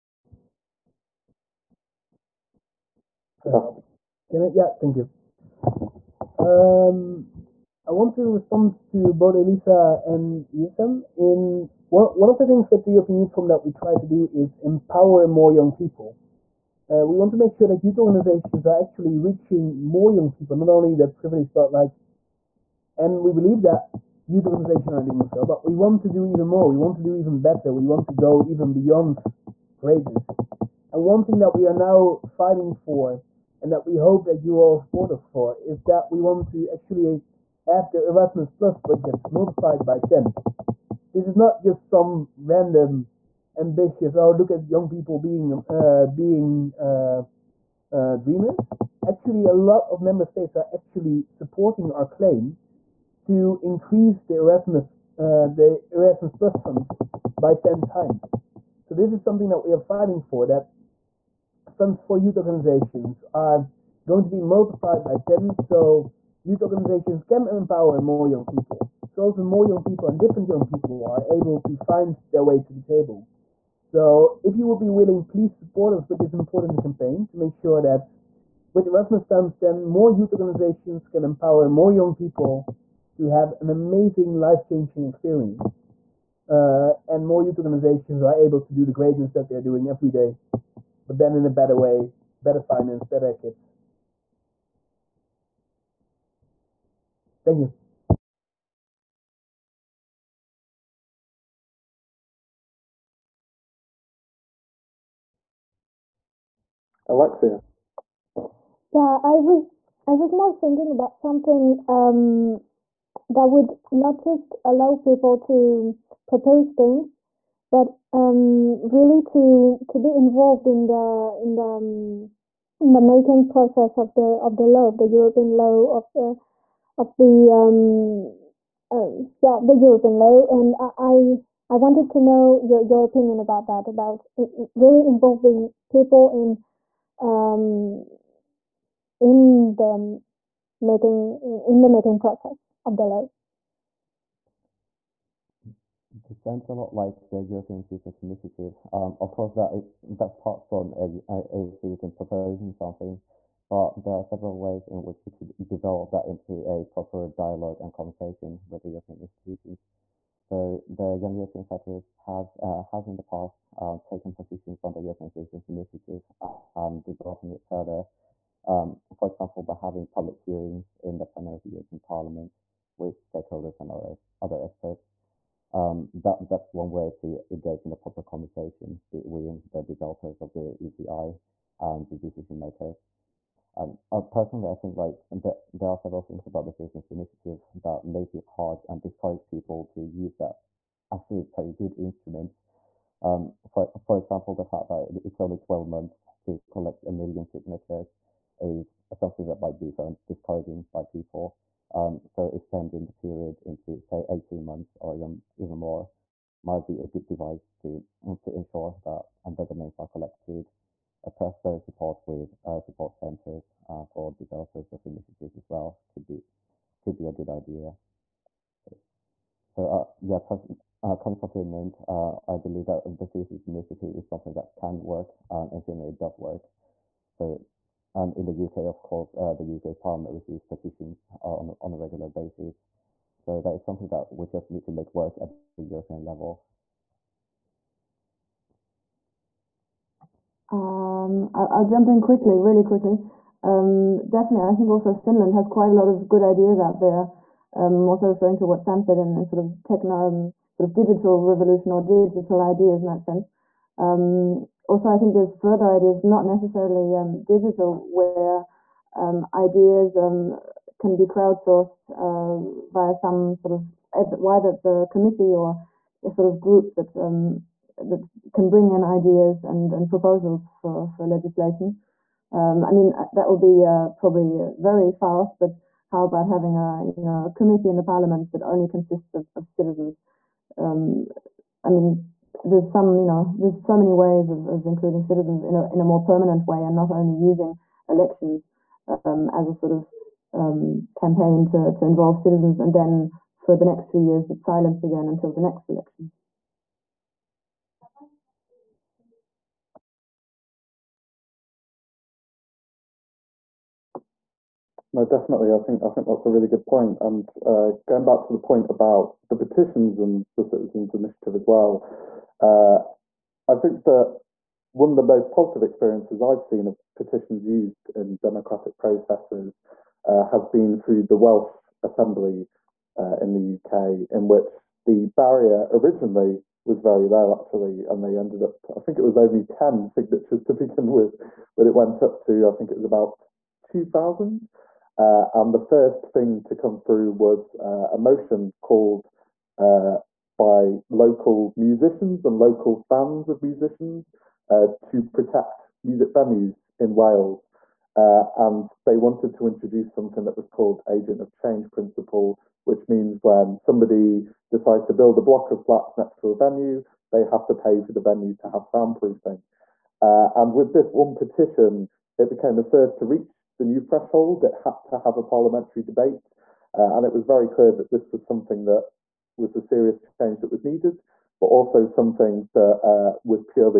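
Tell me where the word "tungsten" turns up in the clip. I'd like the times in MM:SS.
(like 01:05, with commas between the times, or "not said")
not said.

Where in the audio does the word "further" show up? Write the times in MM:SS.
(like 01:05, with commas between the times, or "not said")
02:47, 04:15.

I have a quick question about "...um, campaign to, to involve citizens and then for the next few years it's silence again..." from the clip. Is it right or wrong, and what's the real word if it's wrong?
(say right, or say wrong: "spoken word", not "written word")
right.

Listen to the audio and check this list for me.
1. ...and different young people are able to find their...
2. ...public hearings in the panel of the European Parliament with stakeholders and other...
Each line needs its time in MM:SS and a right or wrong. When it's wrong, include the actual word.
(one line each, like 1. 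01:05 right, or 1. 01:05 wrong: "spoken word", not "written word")
1. 01:10 right
2. 02:50 right.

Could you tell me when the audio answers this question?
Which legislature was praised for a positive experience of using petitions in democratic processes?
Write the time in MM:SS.
05:21.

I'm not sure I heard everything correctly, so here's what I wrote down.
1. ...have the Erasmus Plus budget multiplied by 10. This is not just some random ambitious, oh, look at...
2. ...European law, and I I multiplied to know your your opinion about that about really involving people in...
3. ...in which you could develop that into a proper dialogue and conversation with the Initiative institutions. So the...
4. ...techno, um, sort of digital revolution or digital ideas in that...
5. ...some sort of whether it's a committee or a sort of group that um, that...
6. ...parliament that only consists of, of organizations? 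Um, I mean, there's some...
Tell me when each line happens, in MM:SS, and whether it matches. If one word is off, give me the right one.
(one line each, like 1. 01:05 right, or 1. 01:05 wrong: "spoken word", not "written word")
1. 00:37 right
2. 02:09 wrong: "wanted", not "multiplied"
3. 02:34 wrong: "European", not "Initiative"
4. 04:09 right
5. 04:23 right
6. 04:38 wrong: "citizens", not "organizations".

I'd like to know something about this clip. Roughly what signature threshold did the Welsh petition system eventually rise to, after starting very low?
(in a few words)
2000.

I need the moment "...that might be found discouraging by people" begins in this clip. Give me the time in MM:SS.
03:19.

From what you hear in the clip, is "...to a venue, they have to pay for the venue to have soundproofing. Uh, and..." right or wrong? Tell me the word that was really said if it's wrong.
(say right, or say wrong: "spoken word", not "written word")
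right.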